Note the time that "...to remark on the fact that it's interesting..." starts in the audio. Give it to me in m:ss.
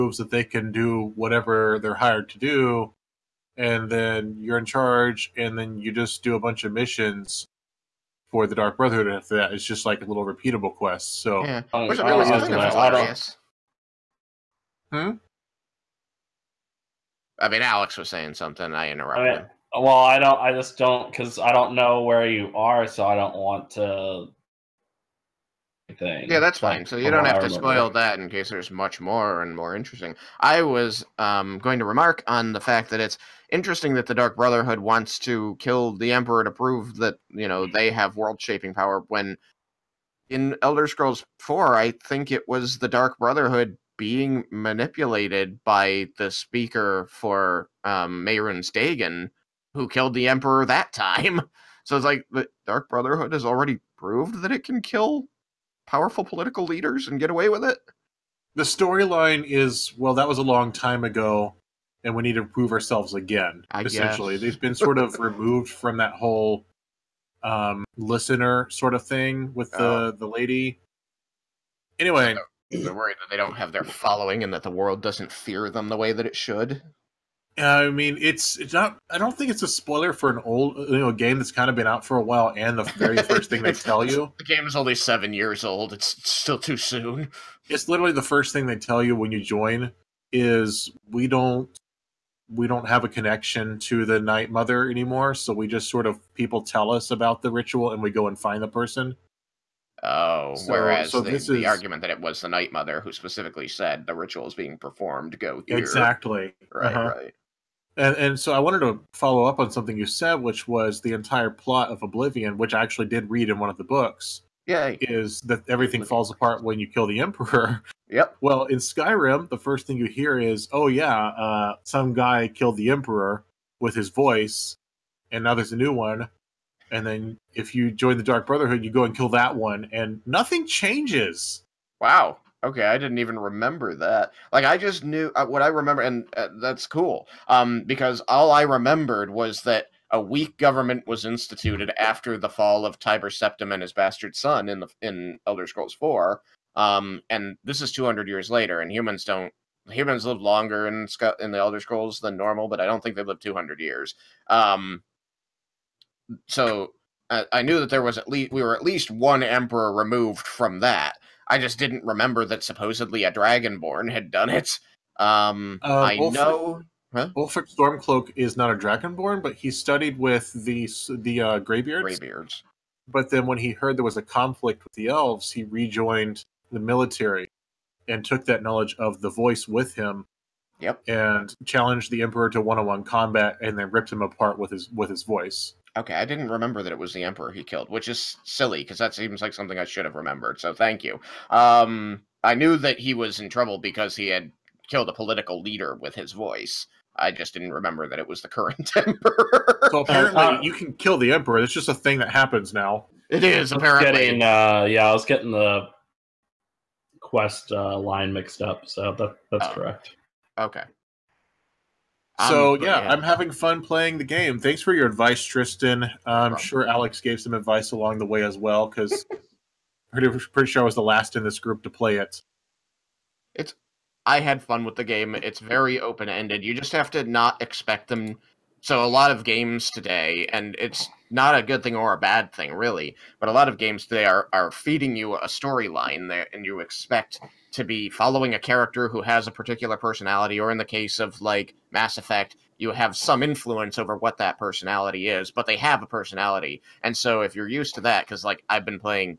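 0:31.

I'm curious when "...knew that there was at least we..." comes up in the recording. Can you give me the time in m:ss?
2:37.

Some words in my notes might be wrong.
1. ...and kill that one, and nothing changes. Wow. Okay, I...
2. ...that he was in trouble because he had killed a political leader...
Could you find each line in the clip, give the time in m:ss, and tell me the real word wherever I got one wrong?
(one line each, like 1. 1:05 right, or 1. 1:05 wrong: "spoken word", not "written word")
1. 2:09 right
2. 3:12 right.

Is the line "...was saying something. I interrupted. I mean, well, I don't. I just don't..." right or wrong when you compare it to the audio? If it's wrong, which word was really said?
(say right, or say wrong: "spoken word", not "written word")
right.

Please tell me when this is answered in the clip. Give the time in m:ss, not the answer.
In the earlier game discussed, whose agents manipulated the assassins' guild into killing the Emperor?
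0:48.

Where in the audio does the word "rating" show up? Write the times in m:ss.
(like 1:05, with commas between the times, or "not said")
not said.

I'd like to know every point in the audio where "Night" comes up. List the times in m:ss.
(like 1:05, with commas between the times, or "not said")
1:34, 1:42.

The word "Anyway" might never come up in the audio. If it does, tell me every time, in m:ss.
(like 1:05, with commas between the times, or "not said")
1:11.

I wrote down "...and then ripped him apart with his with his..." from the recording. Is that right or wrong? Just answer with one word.
right.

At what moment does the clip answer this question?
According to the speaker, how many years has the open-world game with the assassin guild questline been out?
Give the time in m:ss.
1:24.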